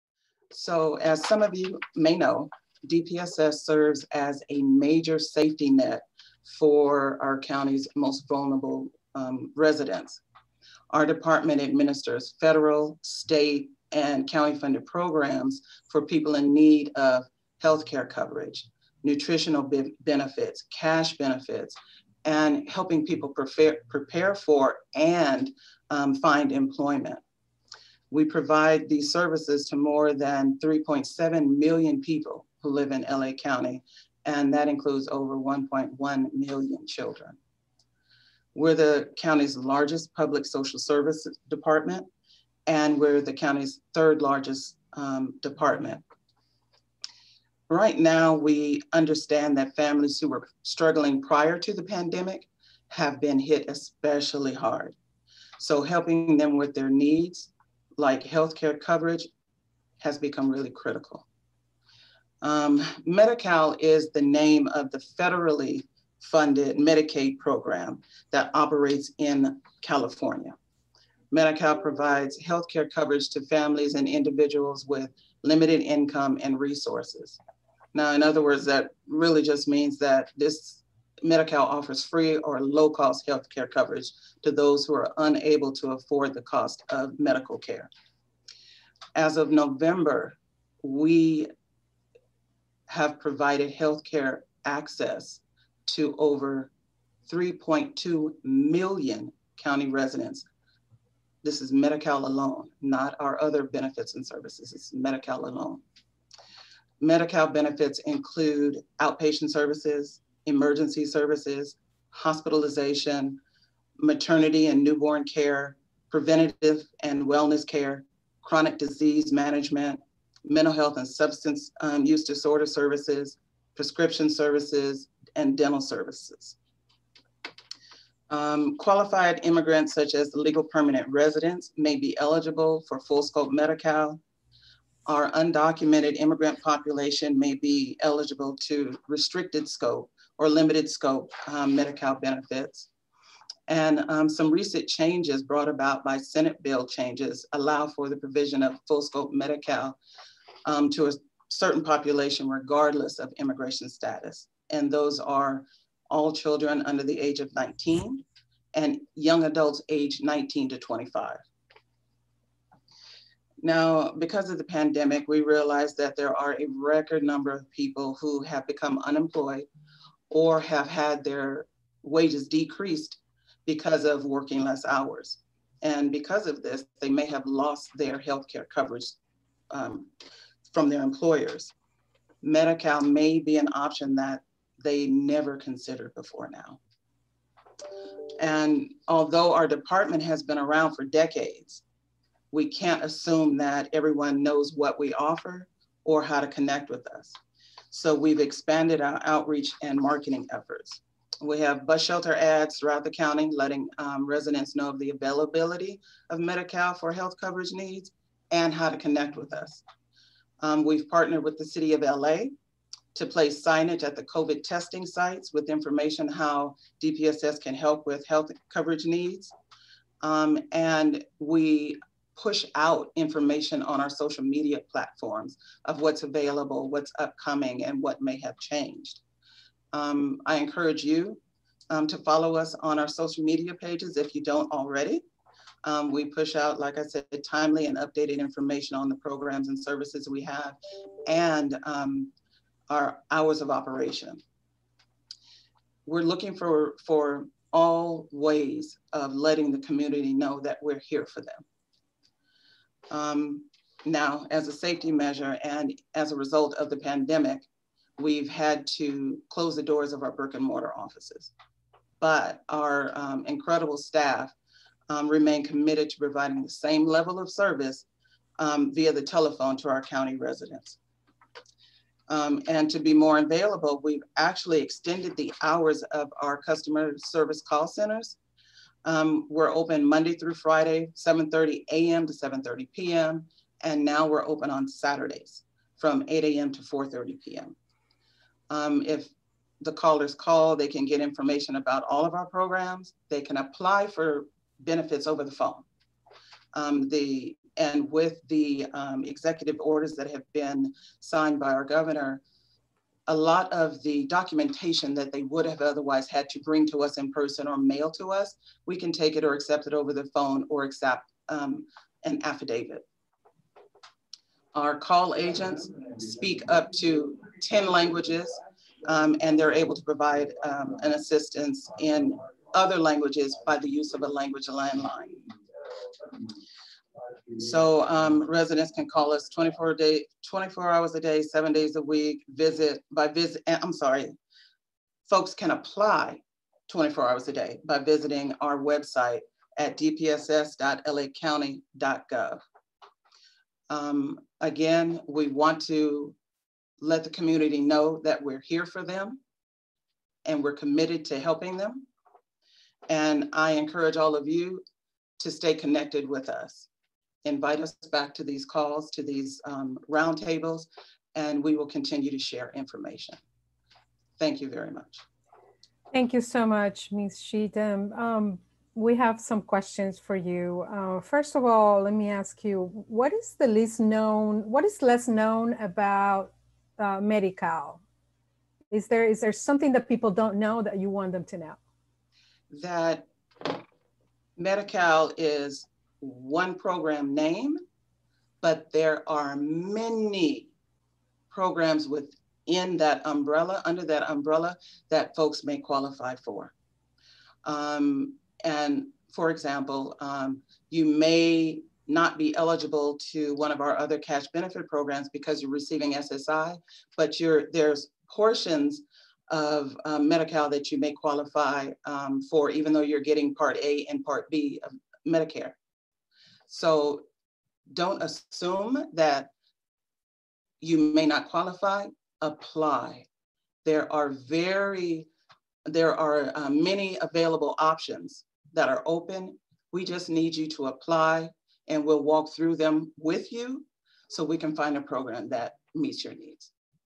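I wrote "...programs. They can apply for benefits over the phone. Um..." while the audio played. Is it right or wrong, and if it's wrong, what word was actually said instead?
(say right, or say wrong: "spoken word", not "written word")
right.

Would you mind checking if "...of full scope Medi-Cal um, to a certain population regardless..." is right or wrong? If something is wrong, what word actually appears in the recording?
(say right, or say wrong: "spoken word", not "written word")
right.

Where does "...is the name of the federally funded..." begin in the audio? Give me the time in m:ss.
1:03.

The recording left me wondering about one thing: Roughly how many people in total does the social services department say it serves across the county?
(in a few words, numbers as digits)
3.7 million.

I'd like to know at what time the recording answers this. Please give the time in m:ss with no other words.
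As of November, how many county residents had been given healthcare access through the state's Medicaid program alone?
1:37.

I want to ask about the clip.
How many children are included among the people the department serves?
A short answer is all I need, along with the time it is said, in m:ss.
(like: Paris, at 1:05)
1.1 million, at 0:35.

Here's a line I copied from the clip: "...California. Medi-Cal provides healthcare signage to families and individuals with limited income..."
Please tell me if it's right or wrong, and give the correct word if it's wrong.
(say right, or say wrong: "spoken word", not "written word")
wrong: "coverage", not "signage".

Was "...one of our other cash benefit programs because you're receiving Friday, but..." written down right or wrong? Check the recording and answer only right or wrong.
wrong.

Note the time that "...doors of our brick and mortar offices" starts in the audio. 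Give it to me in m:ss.
4:19.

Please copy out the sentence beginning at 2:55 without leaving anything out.
And because of this, they may have lost their health care coverage um, from their employers.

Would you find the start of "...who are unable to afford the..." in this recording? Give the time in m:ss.
1:24.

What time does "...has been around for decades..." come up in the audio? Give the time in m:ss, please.
3:10.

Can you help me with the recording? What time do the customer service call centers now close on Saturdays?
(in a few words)
4:30 p.m.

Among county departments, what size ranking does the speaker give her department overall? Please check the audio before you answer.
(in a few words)
third largest.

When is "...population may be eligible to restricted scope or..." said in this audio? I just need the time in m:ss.
2:16.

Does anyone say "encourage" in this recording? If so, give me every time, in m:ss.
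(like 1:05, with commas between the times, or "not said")
3:50, 5:53.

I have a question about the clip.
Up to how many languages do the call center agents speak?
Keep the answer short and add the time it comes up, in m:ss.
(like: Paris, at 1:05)
10, at 5:17.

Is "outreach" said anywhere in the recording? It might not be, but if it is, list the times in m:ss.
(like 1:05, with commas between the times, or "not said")
3:19.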